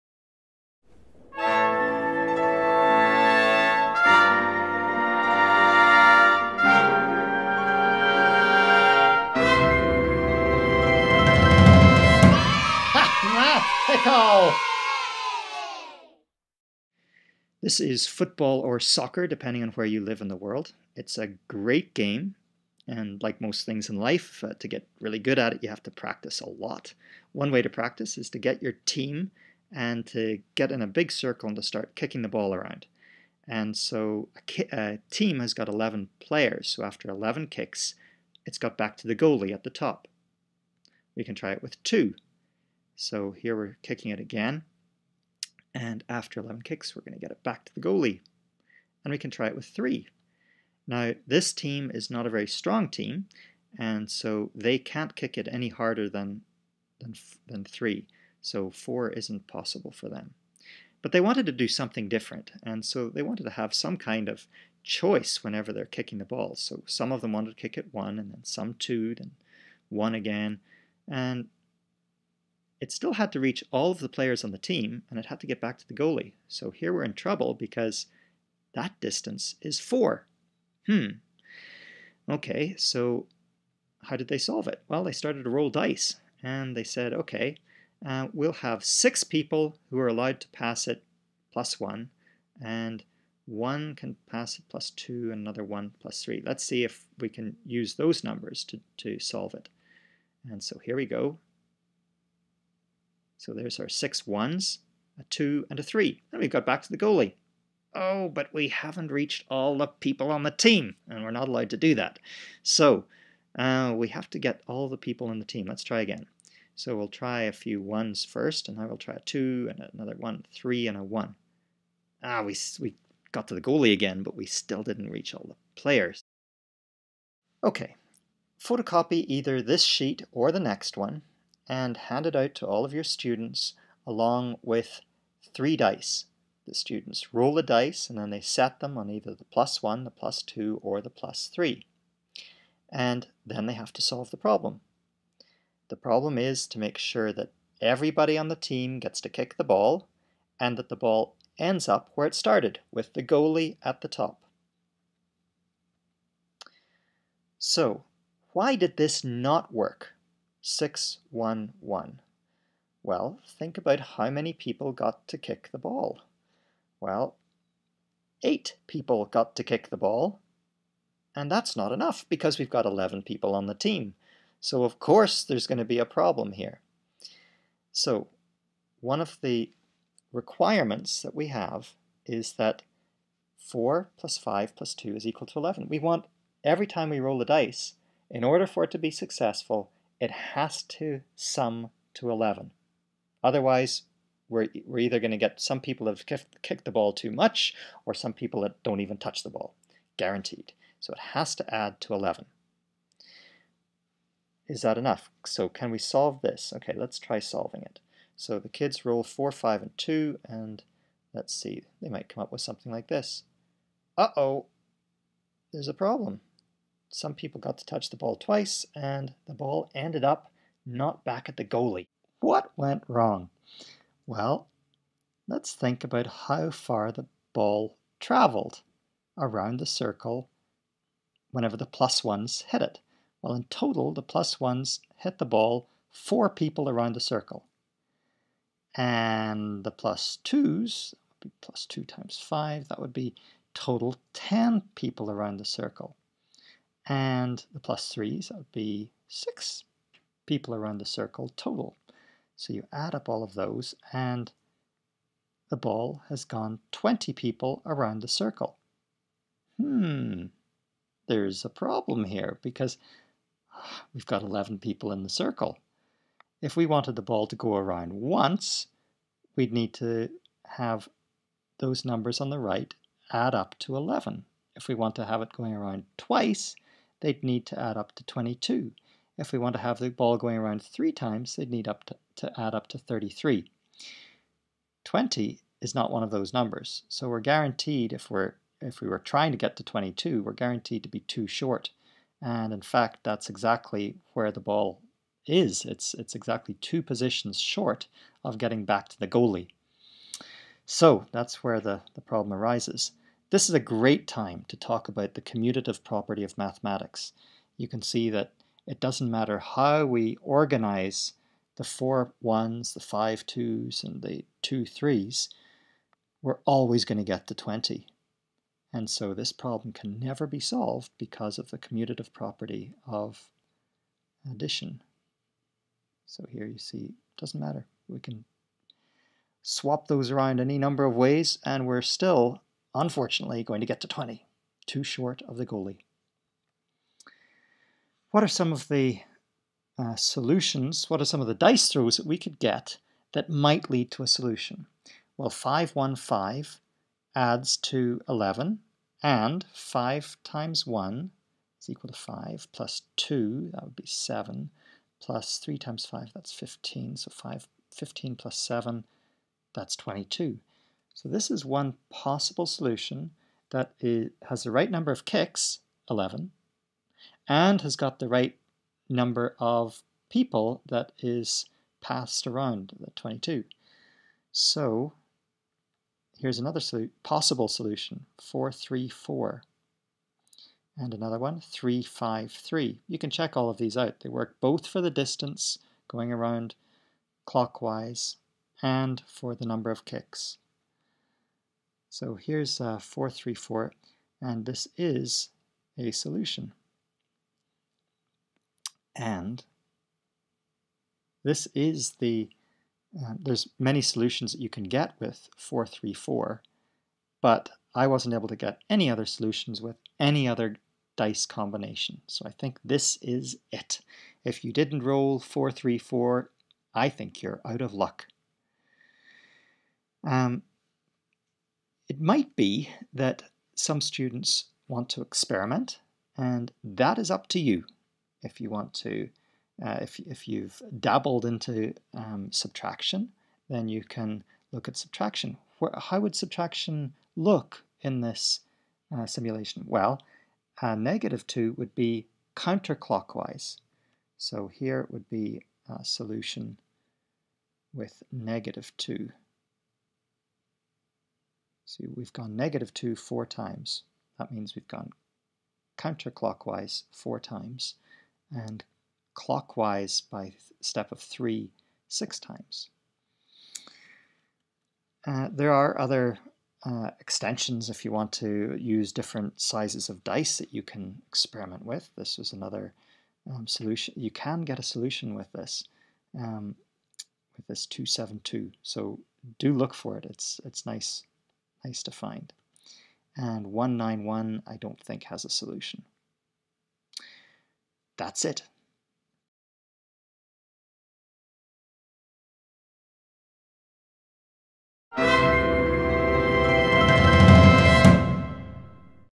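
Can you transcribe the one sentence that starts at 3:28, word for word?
So the kids roll 4, 5, and 2, and let's see, they might come up with something like this.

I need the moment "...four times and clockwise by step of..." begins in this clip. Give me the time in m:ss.
7:37.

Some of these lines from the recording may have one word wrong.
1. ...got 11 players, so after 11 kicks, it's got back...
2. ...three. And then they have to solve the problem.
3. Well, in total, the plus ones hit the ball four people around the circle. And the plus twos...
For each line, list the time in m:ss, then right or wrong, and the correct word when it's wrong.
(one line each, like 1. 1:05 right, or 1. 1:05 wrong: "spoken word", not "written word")
1. 0:35 right
2. 2:21 right
3. 3:53 right.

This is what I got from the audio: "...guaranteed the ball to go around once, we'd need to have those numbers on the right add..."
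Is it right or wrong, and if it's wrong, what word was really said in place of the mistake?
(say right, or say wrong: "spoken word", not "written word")
wrong: "wanted", not "guaranteed".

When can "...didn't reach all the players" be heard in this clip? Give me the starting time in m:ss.
2:04.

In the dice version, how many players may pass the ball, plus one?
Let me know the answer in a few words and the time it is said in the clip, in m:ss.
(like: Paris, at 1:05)
6, at 1:28.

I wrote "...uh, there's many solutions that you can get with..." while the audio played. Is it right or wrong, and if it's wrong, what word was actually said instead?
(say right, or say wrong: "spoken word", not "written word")
right.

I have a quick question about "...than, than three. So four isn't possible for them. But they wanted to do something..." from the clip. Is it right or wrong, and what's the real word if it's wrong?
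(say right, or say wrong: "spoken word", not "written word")
right.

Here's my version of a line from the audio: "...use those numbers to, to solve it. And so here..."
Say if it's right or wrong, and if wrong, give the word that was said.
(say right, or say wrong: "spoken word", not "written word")
right.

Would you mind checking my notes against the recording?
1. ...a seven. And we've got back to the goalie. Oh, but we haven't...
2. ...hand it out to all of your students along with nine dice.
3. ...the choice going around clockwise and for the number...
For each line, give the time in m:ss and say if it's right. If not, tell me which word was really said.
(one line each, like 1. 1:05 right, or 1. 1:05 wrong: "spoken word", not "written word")
1. 1:45 wrong: "three", not "seven"
2. 2:11 wrong: "three", not "nine"
3. 6:25 wrong: "distance", not "choice".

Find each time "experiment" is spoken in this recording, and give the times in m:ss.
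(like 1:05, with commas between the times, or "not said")
7:05, 7:51.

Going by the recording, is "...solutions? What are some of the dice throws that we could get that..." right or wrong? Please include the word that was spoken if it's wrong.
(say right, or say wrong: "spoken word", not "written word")
right.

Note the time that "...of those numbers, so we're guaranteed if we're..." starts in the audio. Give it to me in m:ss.
4:46.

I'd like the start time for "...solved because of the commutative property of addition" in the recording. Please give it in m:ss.
5:20.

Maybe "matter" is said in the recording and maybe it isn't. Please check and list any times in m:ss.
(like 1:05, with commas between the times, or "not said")
5:09, 5:27.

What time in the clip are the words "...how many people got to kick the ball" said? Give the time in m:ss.
2:43.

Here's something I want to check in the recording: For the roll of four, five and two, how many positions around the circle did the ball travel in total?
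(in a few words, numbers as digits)
20.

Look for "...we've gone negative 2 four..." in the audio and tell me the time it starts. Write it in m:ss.
7:32.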